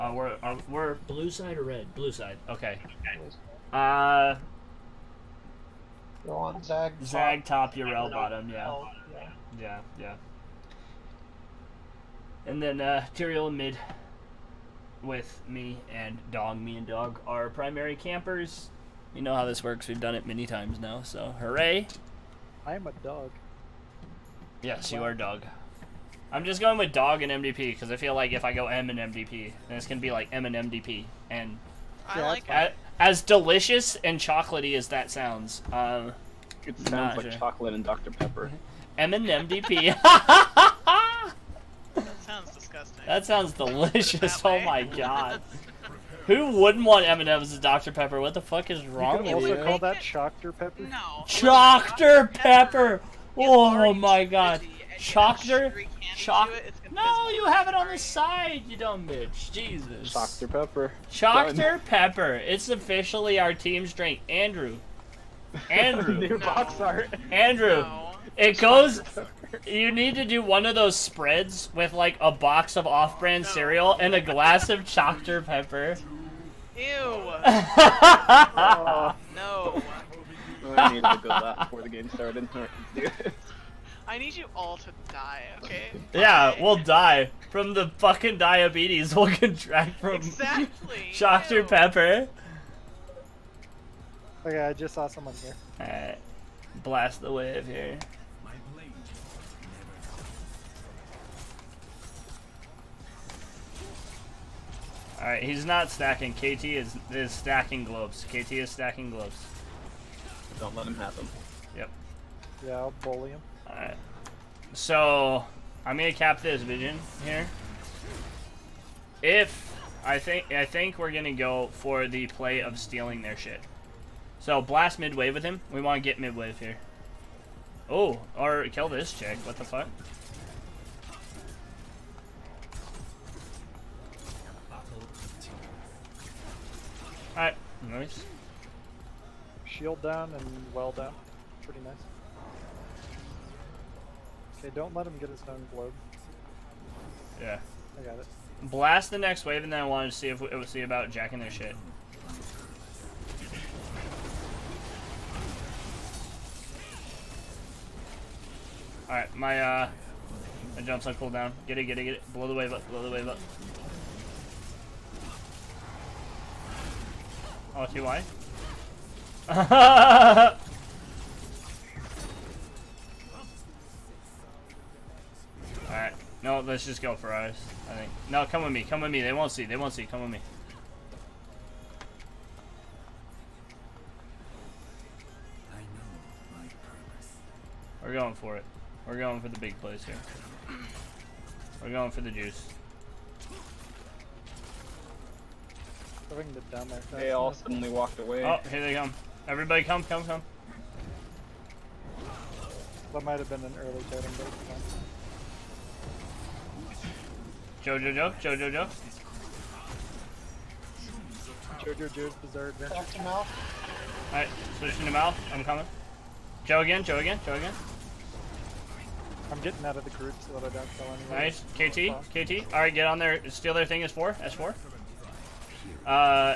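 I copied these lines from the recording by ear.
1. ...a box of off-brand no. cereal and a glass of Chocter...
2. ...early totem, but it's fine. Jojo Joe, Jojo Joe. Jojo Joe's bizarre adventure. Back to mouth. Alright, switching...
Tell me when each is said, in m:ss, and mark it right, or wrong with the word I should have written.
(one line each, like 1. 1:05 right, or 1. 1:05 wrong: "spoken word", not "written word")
1. 1:12 right
2. 3:23 right.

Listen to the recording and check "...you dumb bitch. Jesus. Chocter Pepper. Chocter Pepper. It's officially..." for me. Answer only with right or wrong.
right.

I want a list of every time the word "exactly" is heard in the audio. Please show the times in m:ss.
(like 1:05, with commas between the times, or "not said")
1:30.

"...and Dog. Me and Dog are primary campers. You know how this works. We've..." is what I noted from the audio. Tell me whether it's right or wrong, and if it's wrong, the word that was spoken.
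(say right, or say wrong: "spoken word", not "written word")
right.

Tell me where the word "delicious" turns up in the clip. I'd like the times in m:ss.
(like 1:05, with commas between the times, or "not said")
0:33, 0:43.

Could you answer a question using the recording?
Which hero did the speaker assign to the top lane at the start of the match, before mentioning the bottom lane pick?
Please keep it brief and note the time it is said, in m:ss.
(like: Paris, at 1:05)
Zag, at 0:07.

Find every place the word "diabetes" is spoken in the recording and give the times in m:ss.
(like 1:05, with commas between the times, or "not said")
1:28.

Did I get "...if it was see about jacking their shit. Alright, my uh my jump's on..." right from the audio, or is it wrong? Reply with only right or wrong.
right.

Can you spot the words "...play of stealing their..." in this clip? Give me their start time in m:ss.
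2:02.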